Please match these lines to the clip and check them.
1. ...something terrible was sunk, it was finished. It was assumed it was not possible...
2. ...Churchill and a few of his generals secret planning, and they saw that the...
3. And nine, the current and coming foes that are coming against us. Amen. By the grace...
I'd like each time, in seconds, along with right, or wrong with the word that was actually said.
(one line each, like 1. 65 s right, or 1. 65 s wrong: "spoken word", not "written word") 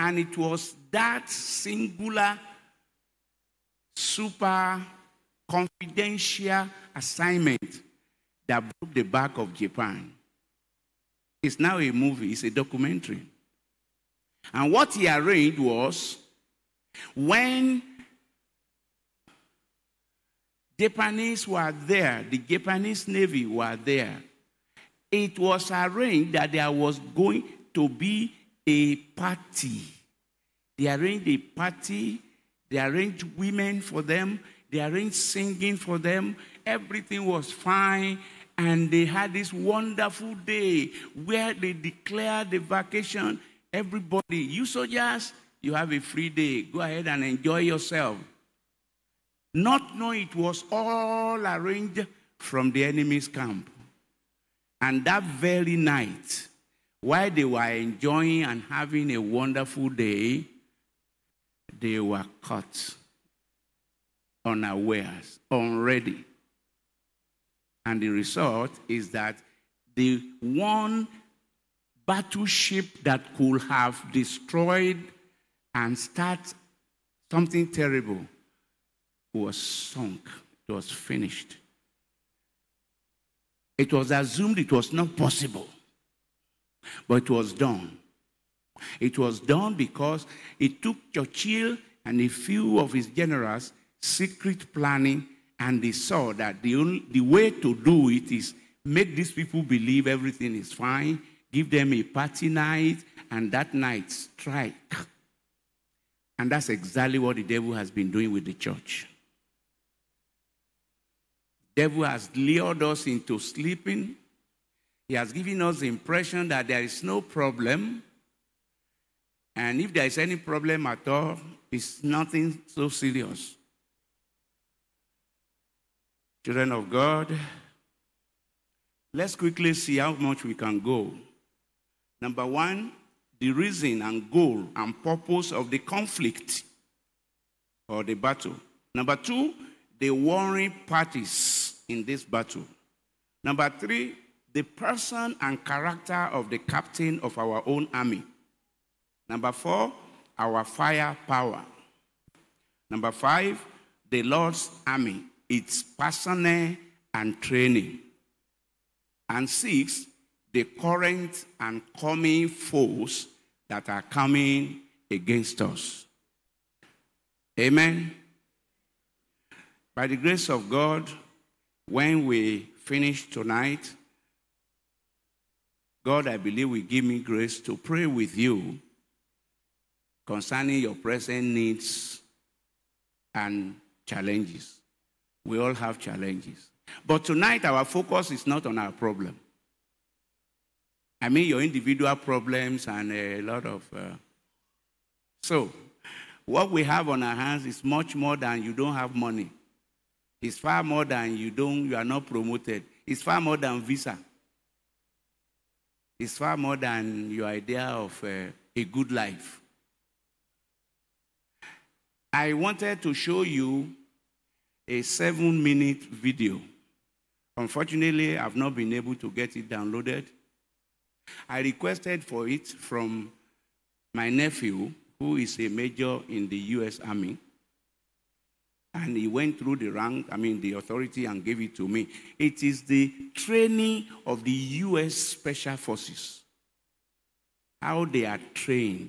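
1. 77 s right
2. 91 s right
3. 159 s wrong: "six", not "nine".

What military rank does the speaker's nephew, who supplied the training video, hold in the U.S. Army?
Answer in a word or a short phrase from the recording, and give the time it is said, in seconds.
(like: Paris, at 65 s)
major, at 225 s.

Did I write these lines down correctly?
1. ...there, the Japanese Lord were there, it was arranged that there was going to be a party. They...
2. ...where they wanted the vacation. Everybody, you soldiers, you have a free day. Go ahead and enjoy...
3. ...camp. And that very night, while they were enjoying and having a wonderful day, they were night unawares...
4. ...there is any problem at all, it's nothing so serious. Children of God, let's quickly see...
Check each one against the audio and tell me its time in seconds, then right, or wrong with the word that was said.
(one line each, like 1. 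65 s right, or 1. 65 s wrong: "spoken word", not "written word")
1. 21 s wrong: "Navy", not "Lord"
2. 41 s wrong: "declared", not "wanted"
3. 53 s wrong: "caught", not "night"
4. 119 s right.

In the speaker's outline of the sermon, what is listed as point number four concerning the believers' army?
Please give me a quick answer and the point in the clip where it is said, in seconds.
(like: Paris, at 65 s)
our fire power, at 150 s.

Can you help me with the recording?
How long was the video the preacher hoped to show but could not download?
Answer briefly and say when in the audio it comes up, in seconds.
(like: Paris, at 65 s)
7 minutes, at 215 s.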